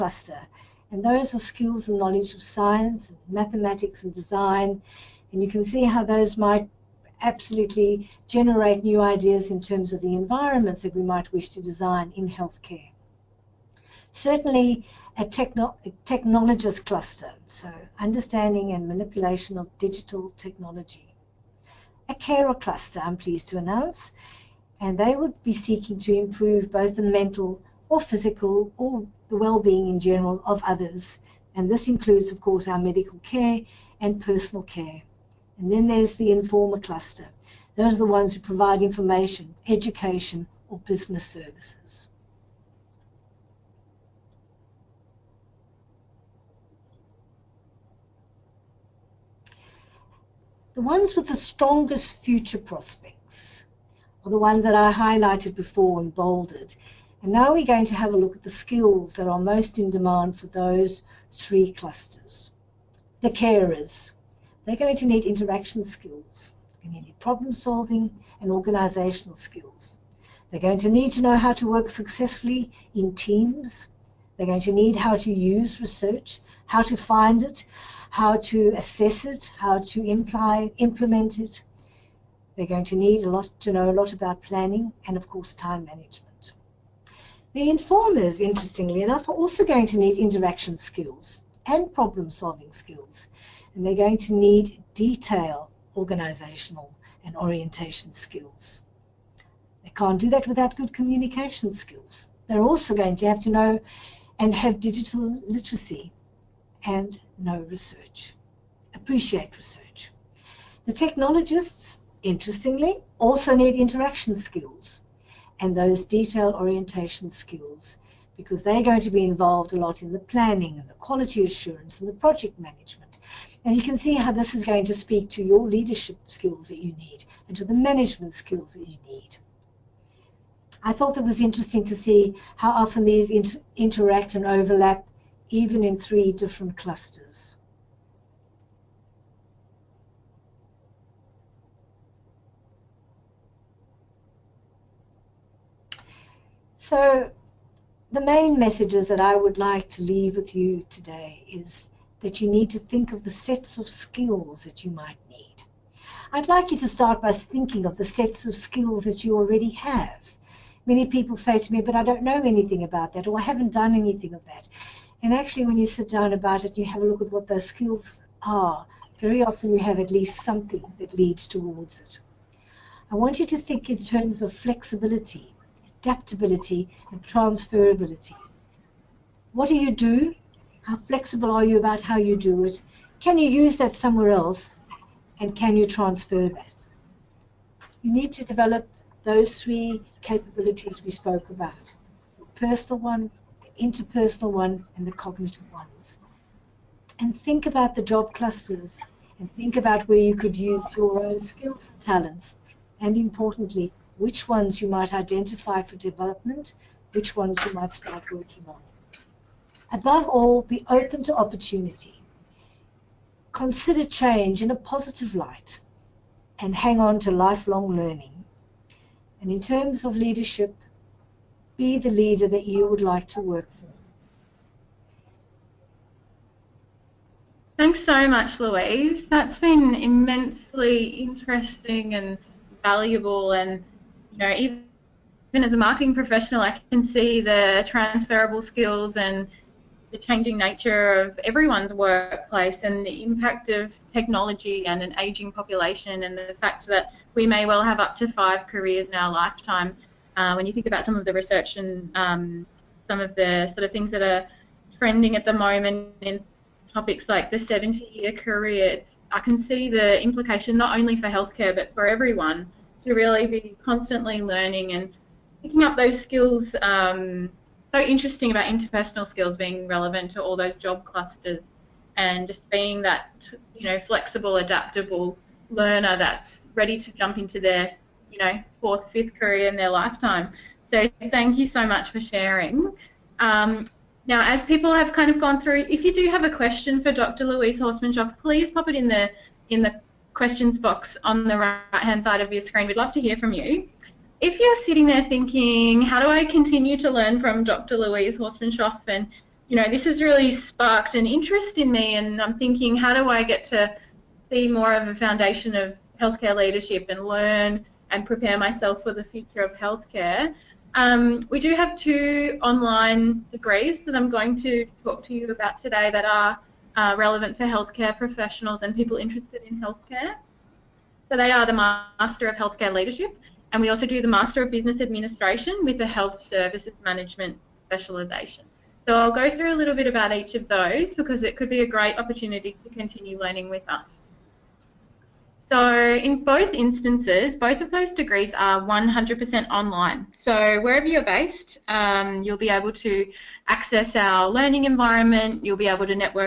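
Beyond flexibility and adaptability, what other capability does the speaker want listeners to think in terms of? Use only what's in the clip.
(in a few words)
transferability.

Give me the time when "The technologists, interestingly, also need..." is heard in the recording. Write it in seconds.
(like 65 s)
110 s.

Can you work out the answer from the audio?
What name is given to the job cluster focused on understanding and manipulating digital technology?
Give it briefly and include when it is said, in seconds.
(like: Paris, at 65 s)
technologist cluster, at 16 s.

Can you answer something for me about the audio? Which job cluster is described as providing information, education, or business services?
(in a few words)
informer cluster.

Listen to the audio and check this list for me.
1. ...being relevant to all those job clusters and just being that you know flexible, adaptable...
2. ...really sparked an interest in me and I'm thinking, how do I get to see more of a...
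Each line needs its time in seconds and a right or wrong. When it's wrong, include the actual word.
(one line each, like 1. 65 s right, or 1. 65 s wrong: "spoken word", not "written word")
1. 269 s right
2. 300 s right.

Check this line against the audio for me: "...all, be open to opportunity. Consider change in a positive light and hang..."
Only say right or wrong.
right.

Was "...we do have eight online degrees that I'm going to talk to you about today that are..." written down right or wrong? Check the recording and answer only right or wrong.
wrong.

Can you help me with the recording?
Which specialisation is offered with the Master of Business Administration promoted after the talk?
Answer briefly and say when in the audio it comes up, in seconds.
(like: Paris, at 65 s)
Health Services Management, at 326 s.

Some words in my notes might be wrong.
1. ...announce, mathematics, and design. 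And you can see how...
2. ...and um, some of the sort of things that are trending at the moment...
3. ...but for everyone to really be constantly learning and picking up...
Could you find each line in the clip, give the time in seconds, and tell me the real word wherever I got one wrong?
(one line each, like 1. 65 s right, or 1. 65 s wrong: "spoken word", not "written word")
1. 2 s wrong: "science", not "announce"
2. 251 s right
3. 261 s right.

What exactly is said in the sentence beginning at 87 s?
The informers, interestingly enough, are also going to need interaction skills and problem-solving skills.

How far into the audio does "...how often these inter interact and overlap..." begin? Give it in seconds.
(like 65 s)
132 s.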